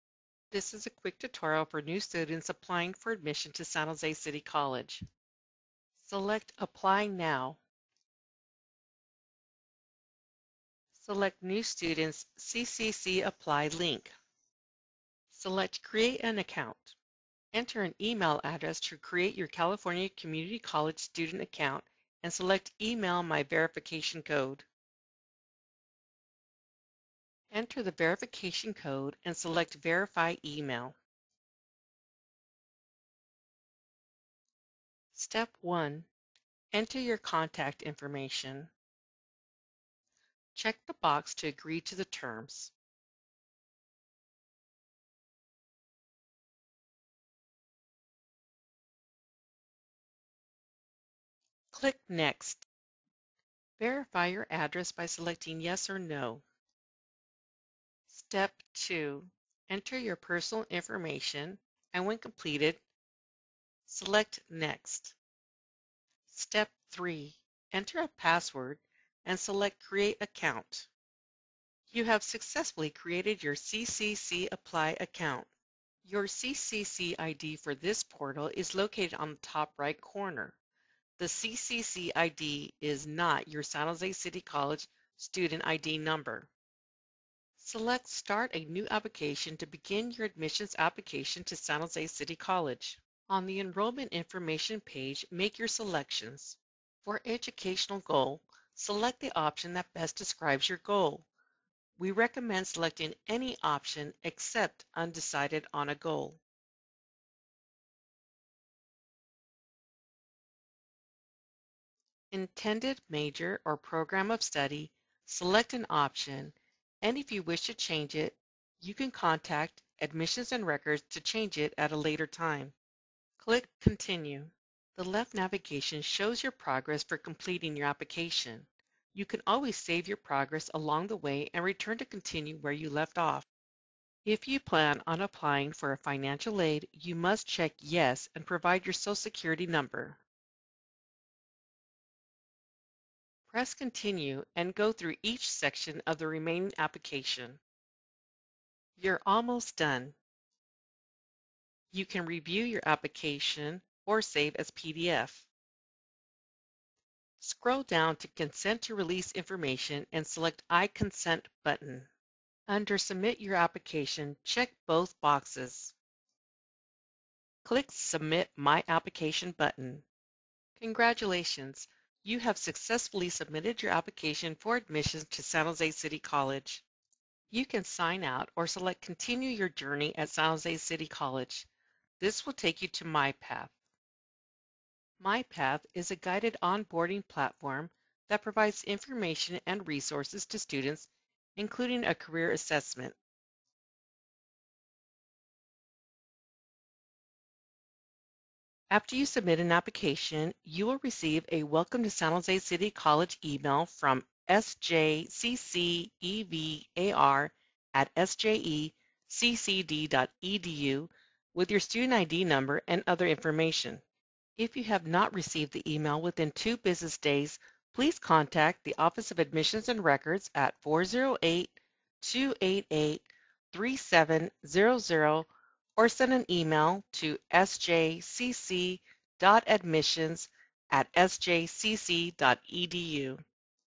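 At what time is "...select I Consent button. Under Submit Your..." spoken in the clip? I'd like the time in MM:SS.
02:40.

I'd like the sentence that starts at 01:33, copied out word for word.
On the enrollment information page, make your selections.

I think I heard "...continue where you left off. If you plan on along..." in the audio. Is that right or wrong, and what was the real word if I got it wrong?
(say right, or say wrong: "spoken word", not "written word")
wrong: "applying", not "along".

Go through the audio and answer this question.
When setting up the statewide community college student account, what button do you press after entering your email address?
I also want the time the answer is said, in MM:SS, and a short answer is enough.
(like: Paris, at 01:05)
Email My Verification Code, at 00:22.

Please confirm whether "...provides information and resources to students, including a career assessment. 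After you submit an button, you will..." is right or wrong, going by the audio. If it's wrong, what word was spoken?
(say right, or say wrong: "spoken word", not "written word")
wrong: "application", not "button".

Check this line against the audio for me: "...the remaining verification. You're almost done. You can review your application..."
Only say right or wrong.
wrong.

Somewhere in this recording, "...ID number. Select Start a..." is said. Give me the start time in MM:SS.
01:25.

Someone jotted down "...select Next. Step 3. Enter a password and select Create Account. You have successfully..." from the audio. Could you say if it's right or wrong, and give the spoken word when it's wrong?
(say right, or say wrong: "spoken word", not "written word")
right.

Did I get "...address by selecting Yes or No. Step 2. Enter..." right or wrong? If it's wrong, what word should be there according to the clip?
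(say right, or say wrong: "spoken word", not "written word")
right.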